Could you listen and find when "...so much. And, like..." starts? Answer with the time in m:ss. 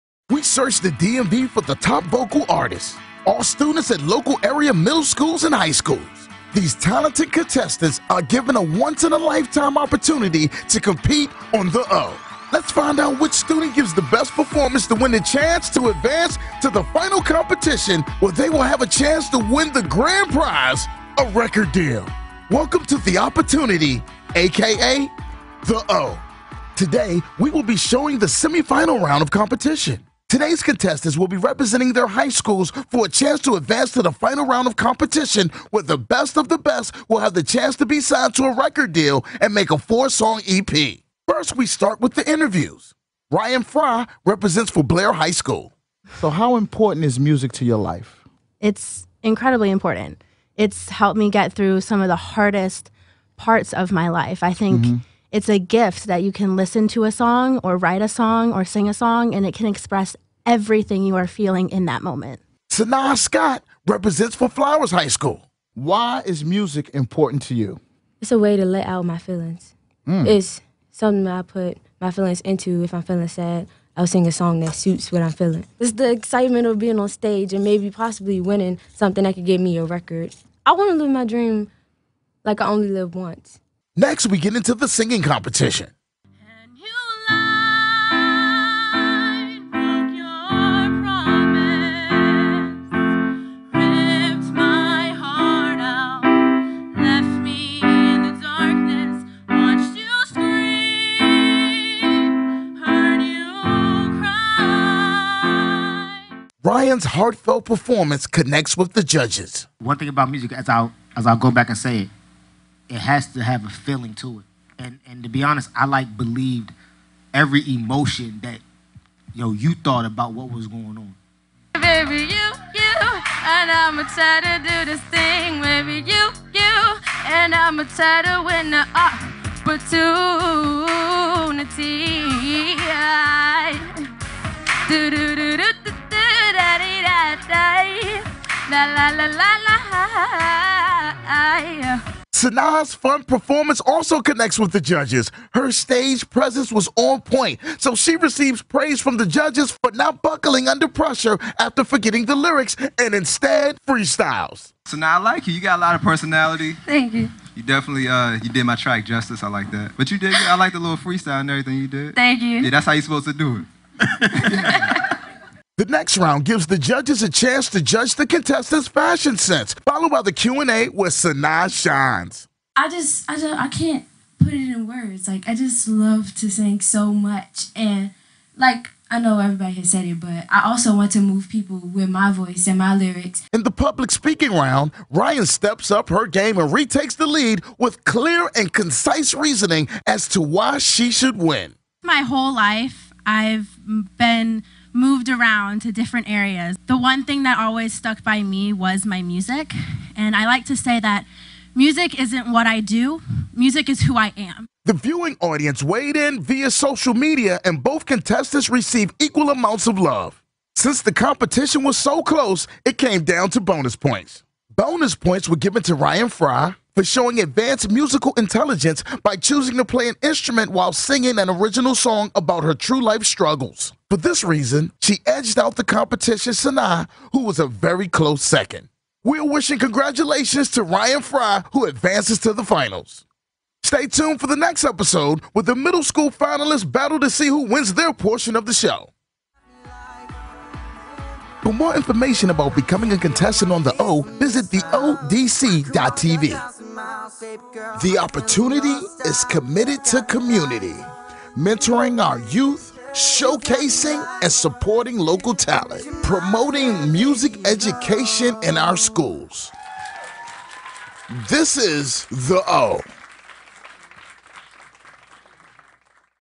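2:56.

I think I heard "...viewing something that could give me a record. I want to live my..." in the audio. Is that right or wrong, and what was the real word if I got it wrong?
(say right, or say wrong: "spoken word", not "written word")
wrong: "winning", not "viewing".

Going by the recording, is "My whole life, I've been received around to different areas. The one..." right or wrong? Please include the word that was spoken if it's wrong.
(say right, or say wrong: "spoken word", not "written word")
wrong: "moved", not "received".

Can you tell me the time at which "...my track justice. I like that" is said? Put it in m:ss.
2:38.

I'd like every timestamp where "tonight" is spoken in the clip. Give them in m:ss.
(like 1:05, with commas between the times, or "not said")
not said.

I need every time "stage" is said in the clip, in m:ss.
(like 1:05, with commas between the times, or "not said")
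1:17, 2:25.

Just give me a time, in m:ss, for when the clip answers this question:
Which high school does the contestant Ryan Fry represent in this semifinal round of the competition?
0:44.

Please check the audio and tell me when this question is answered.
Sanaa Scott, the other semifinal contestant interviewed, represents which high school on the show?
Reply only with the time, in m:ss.
1:04.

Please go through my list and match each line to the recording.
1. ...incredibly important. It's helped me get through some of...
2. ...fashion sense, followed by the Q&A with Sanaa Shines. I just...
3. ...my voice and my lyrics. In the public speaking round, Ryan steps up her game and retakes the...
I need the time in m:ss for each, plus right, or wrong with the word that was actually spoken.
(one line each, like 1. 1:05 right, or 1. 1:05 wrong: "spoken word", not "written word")
1. 0:49 right
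2. 2:48 right
3. 3:02 right.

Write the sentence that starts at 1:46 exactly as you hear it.
Ryan's heartfelt performance connects with the judges.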